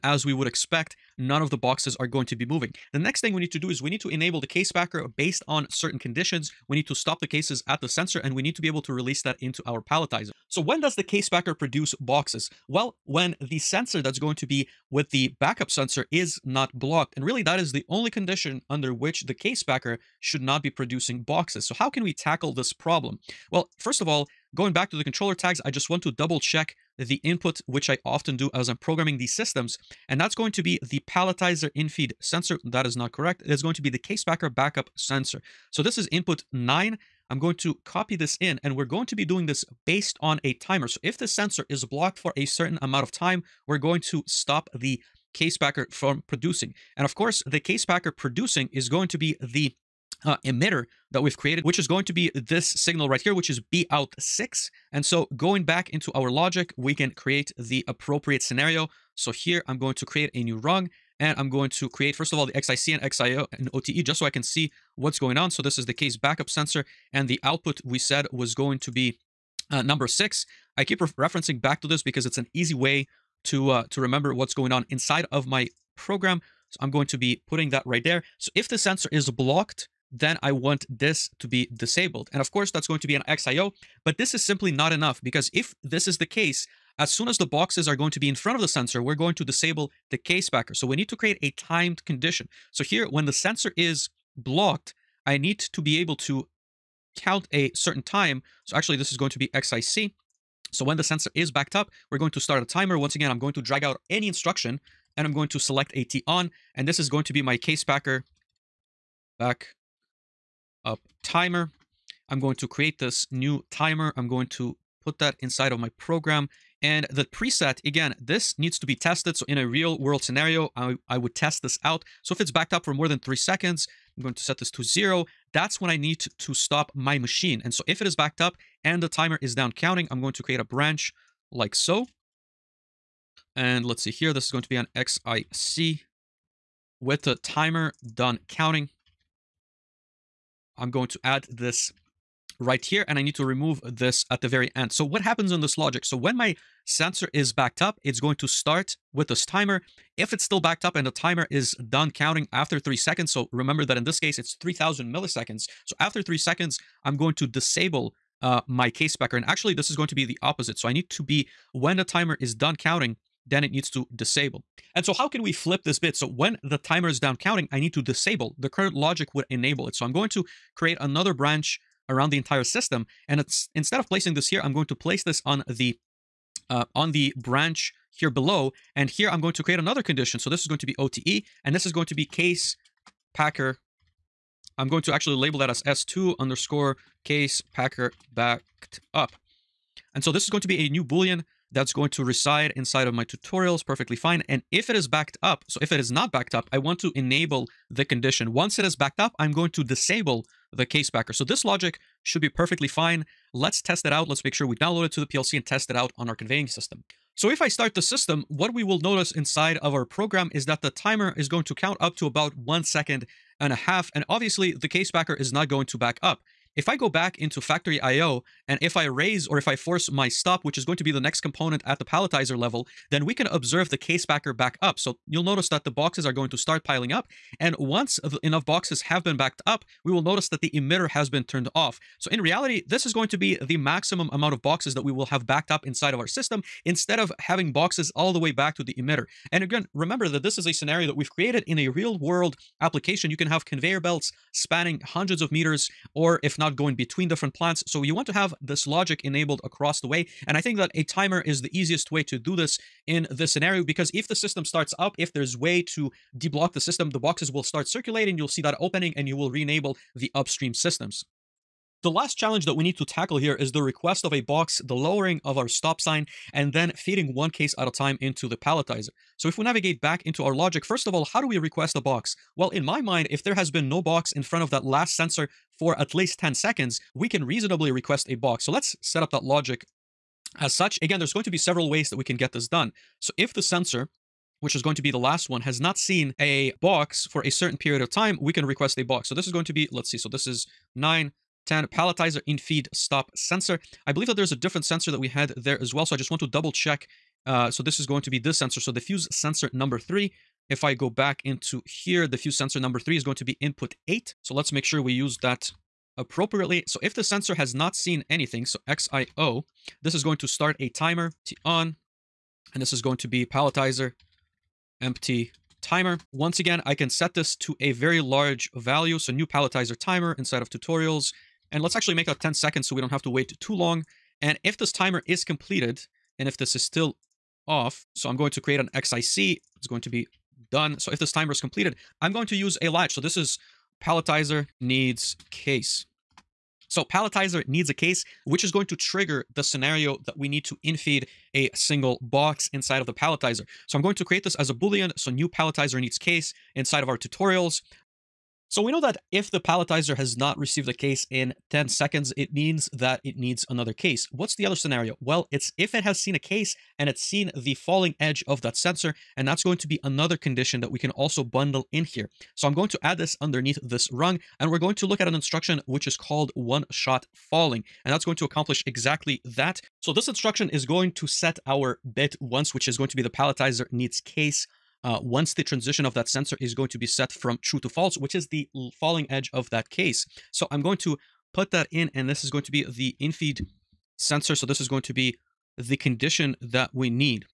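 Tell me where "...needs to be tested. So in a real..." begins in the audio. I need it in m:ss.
1:58.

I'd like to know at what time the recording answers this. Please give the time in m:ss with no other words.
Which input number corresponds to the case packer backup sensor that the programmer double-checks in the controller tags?
0:36.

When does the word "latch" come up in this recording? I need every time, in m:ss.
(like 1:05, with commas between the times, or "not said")
5:32.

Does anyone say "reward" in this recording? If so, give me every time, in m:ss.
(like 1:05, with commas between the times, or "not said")
not said.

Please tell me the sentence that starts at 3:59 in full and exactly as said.
And again, remember that this is a scenario that we've created in a real world application.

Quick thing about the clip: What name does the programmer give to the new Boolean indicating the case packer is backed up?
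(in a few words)
S2_case packer backed up.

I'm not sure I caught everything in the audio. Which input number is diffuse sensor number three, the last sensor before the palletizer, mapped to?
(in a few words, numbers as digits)
8.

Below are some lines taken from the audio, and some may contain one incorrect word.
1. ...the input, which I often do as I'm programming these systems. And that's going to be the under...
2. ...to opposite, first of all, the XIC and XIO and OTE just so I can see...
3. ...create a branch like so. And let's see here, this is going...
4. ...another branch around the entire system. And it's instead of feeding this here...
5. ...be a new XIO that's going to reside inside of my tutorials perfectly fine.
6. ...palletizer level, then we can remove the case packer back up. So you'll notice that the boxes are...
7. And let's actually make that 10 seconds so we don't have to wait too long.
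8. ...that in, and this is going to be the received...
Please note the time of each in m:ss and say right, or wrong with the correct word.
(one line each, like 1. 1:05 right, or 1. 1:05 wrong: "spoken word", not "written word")
1. 0:26 wrong: "palletizer", not "under"
2. 1:01 wrong: "create", not "opposite"
3. 2:10 right
4. 2:50 wrong: "placing", not "feeding"
5. 3:10 wrong: "Boolean", not "XIO"
6. 3:42 wrong: "observe", not "remove"
7. 5:21 right
8. 6:21 wrong: "infeed", not "received".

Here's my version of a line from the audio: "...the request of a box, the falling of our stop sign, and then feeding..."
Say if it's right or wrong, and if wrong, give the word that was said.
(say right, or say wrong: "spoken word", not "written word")
wrong: "lowering", not "falling".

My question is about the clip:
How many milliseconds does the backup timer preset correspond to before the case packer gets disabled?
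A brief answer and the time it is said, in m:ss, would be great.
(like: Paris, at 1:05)
3000, at 2:34.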